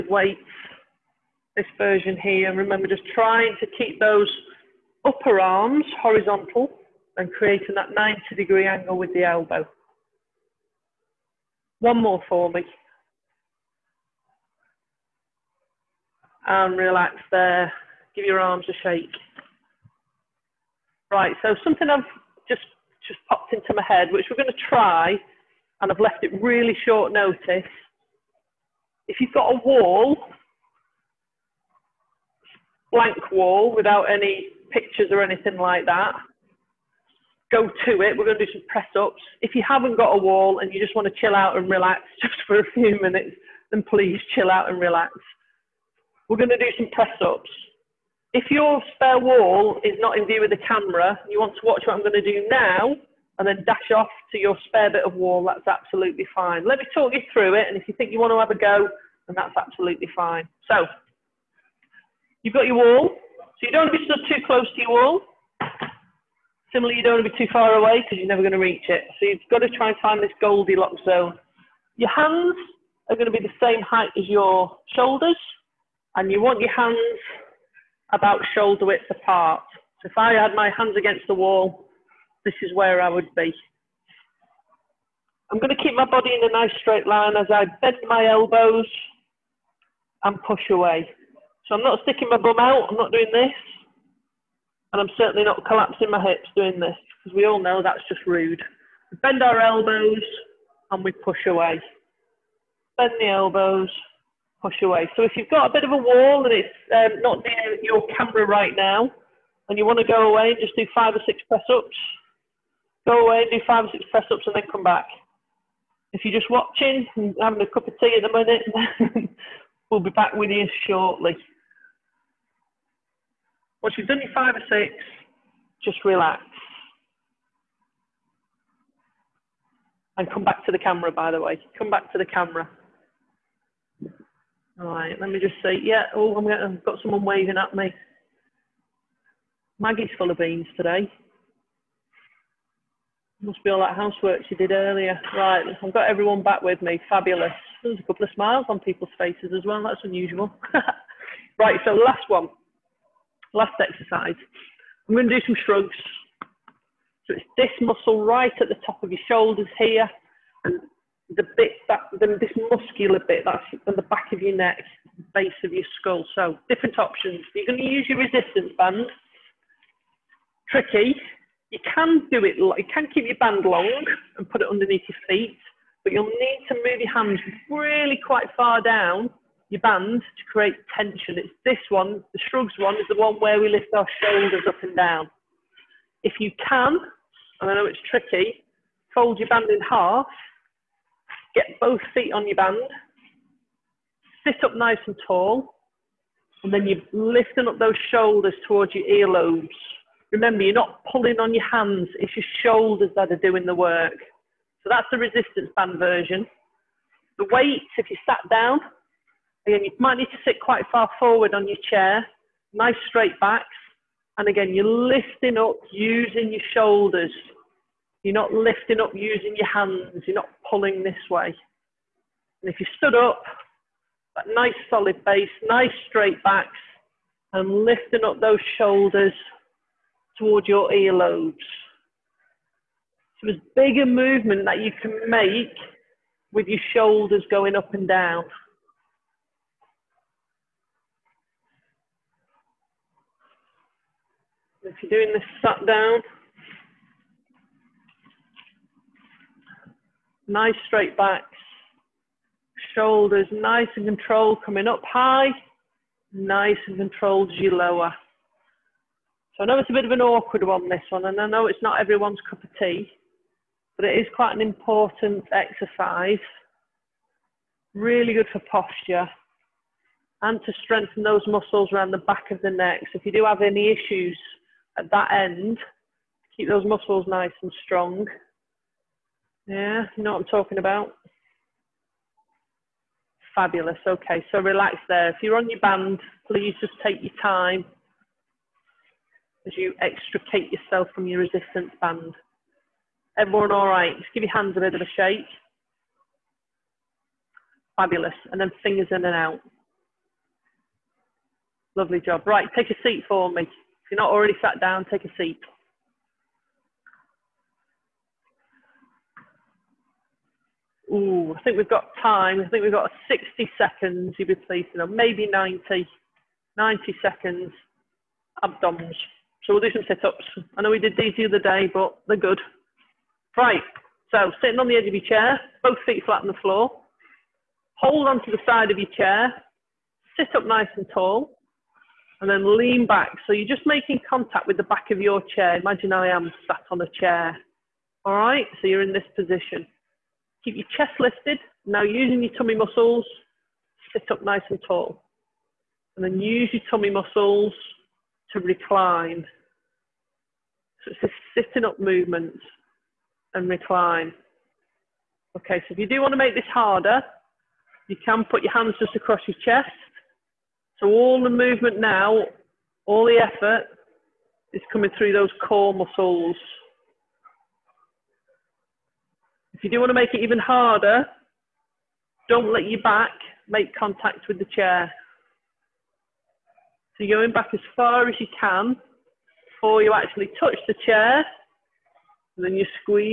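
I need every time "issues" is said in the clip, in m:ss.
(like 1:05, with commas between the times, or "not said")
4:33.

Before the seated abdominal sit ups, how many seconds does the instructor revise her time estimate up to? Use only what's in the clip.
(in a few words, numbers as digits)
90 seconds.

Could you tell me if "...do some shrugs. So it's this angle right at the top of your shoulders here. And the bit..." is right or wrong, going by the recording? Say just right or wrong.
wrong.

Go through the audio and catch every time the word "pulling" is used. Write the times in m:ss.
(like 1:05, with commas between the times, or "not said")
3:21, 3:40.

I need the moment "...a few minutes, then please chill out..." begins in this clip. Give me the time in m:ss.
0:42.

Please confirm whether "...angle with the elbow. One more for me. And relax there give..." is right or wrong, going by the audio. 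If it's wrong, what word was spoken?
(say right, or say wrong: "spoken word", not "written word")
right.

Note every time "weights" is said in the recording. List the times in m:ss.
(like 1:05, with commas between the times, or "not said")
0:00, 3:27.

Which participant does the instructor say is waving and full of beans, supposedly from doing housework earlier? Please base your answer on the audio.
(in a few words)
Maggie.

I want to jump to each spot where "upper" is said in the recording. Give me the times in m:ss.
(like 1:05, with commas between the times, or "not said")
0:05.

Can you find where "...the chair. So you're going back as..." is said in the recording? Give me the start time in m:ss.
6:14.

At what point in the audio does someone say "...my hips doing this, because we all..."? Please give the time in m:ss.
1:36.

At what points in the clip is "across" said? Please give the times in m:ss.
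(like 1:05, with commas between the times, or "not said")
5:59.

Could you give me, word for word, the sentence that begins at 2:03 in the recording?
Once you've done your five or six, just relax.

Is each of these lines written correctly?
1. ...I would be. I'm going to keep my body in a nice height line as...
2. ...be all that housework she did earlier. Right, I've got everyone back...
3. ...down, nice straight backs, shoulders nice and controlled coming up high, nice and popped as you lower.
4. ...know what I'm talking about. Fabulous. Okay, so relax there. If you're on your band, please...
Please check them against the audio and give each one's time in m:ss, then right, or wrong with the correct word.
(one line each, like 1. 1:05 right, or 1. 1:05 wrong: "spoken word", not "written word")
1. 1:23 wrong: "straight", not "height"
2. 2:23 right
3. 4:05 wrong: "controlled", not "popped"
4. 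4:40 right.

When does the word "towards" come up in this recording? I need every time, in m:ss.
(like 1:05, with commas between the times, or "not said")
3:18, 3:50.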